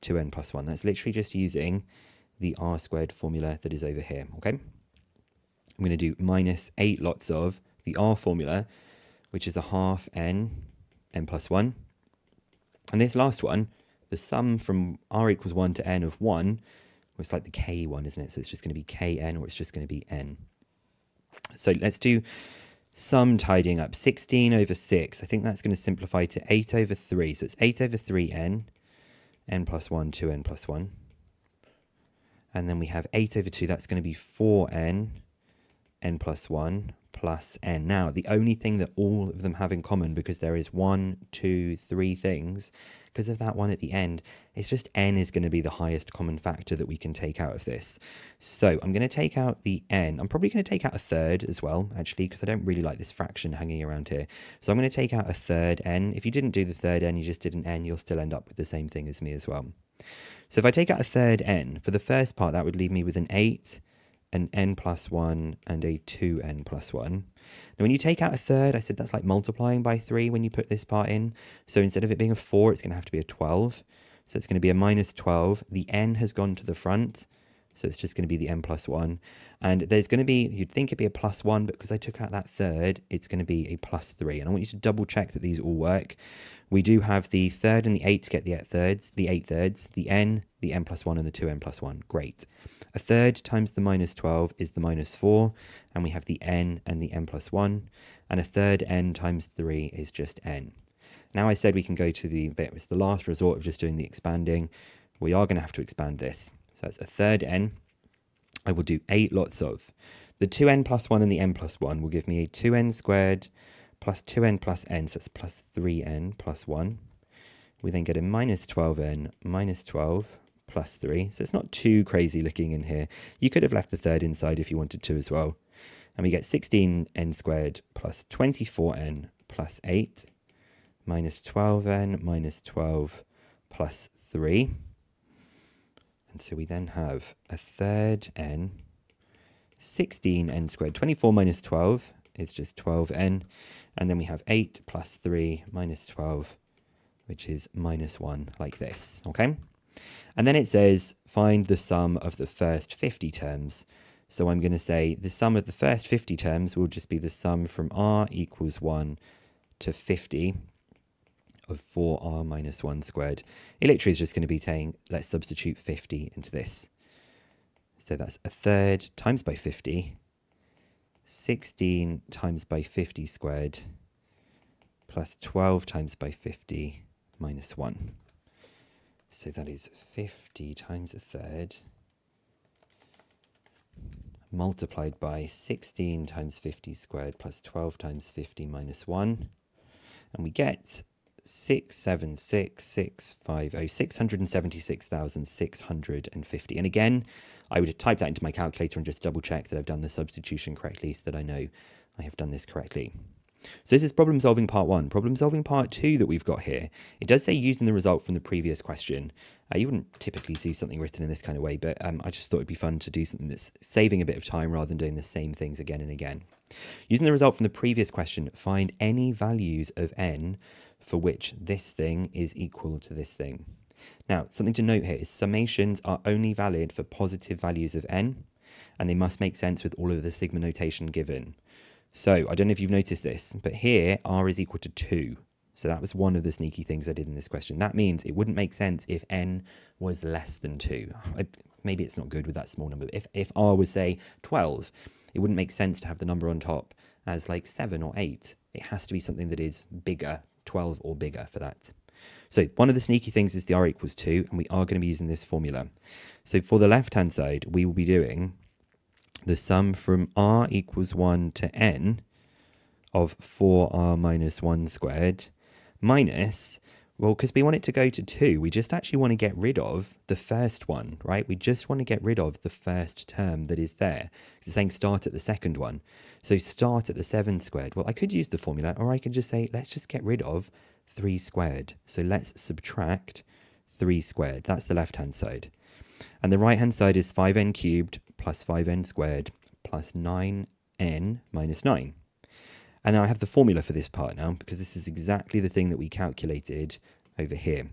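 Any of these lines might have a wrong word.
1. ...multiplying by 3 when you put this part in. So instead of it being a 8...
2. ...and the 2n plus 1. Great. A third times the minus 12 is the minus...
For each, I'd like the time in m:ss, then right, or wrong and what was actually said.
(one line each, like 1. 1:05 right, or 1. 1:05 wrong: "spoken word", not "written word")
1. 1:09 wrong: "4", not "8"
2. 1:31 right.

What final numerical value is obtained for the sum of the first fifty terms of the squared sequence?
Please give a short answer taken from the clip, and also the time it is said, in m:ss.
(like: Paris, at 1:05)
676,650, at 3:11.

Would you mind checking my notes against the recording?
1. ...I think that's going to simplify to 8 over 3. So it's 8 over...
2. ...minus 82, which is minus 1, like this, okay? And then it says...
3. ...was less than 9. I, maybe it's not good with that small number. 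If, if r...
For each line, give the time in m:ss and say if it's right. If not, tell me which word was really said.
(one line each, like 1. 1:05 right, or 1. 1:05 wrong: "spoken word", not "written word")
1. 0:25 right
2. 2:25 wrong: "12", not "82"
3. 3:59 wrong: "2", not "9".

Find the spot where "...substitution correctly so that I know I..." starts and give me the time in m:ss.
3:20.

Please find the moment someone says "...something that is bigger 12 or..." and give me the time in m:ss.
4:09.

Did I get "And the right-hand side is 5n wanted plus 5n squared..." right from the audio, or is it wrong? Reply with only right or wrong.
wrong.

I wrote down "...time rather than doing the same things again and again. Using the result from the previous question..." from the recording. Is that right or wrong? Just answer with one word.
right.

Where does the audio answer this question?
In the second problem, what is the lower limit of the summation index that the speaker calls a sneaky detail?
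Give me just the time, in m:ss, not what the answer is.
3:54.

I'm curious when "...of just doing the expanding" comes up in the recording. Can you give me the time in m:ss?
1:43.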